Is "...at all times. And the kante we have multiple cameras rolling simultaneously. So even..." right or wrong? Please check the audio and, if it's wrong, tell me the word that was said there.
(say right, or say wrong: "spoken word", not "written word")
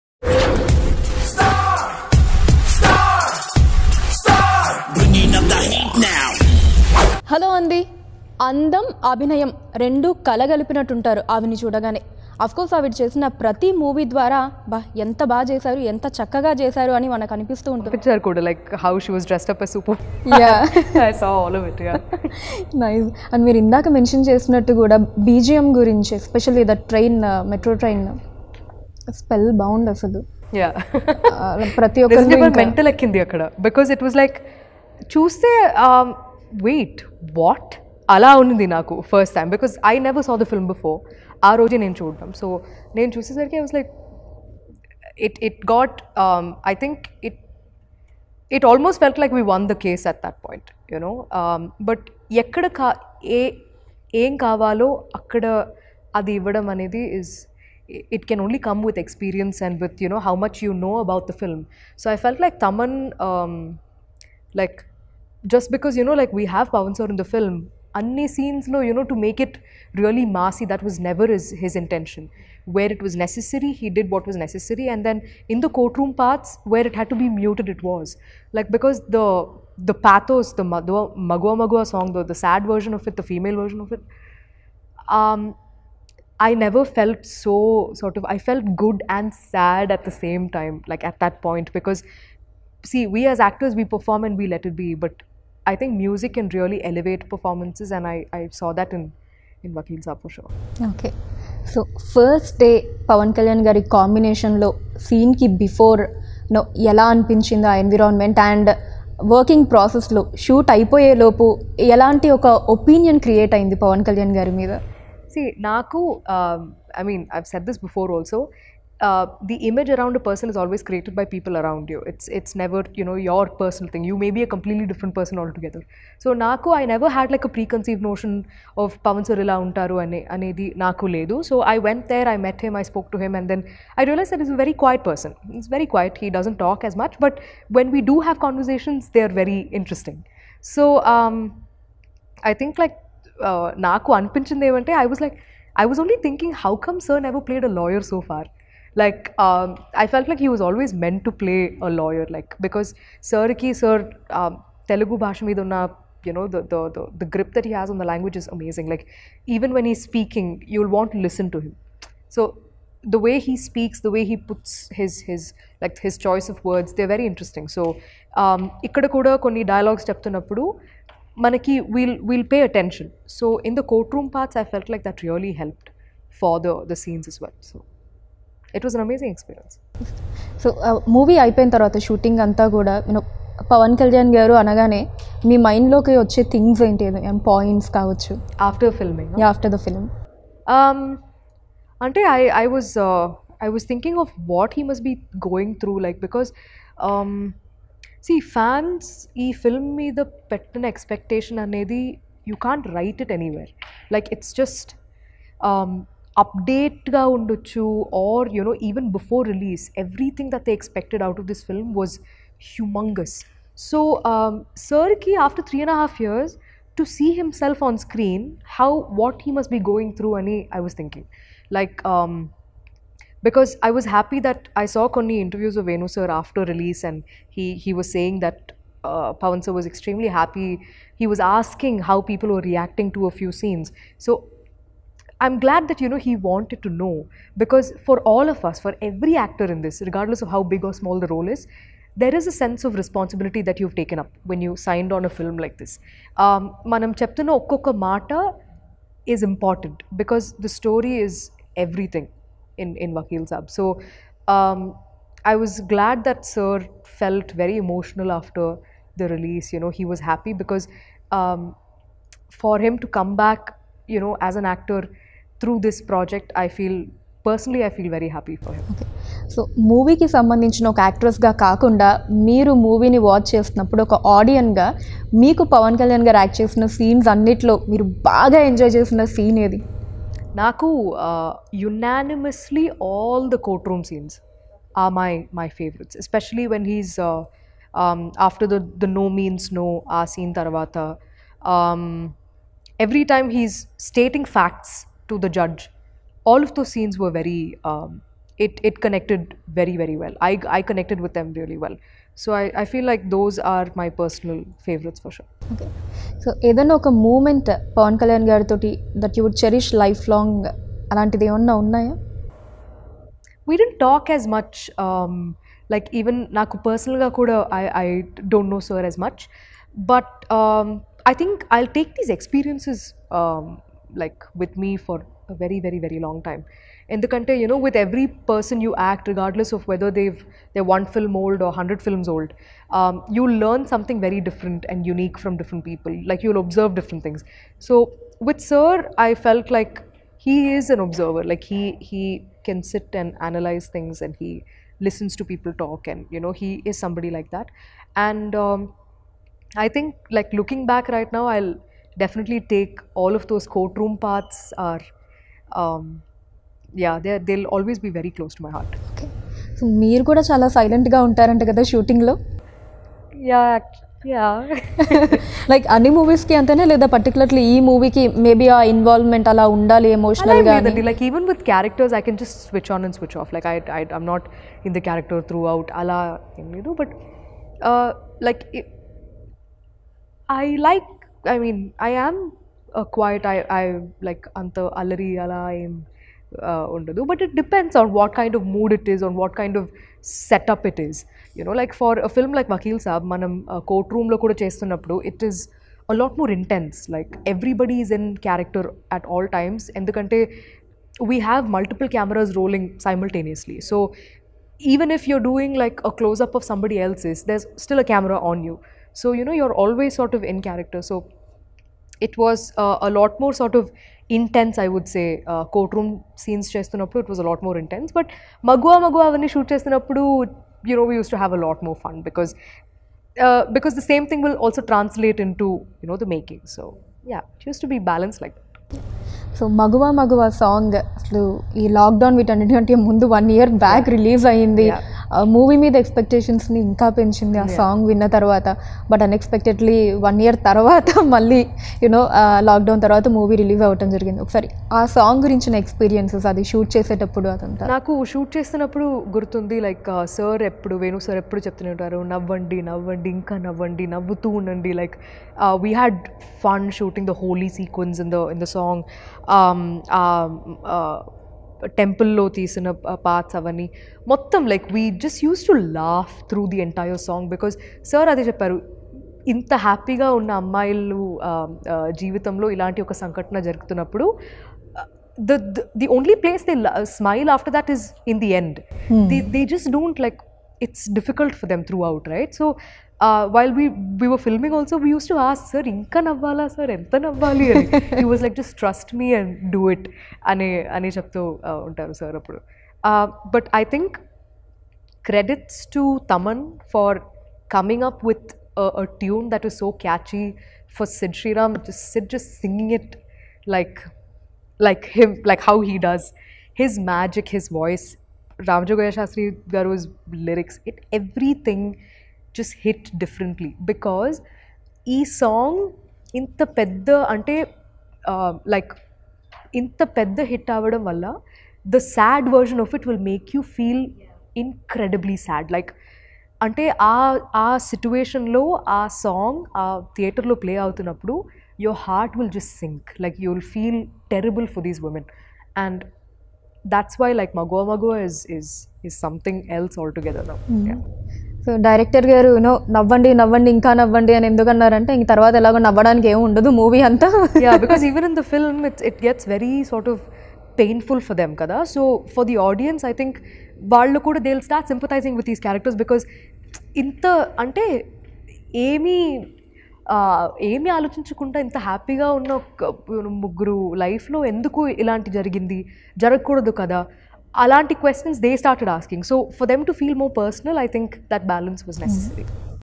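right.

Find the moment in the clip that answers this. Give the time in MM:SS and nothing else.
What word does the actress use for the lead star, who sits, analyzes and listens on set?
05:40.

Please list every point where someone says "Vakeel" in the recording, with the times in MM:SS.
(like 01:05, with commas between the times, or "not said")
04:13, 06:32.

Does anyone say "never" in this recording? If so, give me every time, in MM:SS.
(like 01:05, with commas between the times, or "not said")
01:10, 01:26, 02:02, 02:06, 02:27.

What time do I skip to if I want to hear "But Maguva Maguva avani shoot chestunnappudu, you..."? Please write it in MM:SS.
06:58.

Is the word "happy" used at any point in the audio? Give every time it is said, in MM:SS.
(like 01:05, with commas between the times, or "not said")
03:44, 03:50, 04:20, 04:28.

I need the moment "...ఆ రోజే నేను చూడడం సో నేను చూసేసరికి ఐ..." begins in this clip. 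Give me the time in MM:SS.
00:41.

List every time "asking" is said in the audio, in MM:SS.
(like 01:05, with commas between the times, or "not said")
03:51, 09:28.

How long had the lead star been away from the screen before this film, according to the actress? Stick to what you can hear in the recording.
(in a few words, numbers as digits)
3 and a half years.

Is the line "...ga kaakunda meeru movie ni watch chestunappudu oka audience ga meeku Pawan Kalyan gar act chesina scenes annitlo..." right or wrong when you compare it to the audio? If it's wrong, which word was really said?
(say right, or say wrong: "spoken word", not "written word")
right.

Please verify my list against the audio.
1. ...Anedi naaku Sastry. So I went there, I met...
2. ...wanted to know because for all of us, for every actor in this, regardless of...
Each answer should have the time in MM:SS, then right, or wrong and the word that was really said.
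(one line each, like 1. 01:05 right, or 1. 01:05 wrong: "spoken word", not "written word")
1. 02:10 wrong: "Ledu", not "Sastry"
2. 03:56 right.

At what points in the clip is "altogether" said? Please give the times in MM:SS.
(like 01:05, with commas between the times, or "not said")
02:05, 09:00.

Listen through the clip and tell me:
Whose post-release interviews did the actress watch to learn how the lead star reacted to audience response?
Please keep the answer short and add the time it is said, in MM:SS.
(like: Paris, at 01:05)
Venu, at 03:45.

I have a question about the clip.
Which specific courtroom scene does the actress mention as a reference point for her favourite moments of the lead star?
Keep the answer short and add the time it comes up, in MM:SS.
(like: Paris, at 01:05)
no means no, at 04:49.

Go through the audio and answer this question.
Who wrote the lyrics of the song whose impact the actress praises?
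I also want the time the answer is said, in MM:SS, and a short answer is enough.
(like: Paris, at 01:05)
Ramajogayya Sastry, at 08:28.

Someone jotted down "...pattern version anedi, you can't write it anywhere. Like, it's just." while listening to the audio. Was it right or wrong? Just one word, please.
wrong.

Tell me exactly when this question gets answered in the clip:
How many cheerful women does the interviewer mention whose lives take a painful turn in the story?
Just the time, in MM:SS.
09:23.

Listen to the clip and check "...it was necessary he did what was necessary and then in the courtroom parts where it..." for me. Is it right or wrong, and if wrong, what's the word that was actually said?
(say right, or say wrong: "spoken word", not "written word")
right.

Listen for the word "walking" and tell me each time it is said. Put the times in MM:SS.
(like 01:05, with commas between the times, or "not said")
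not said.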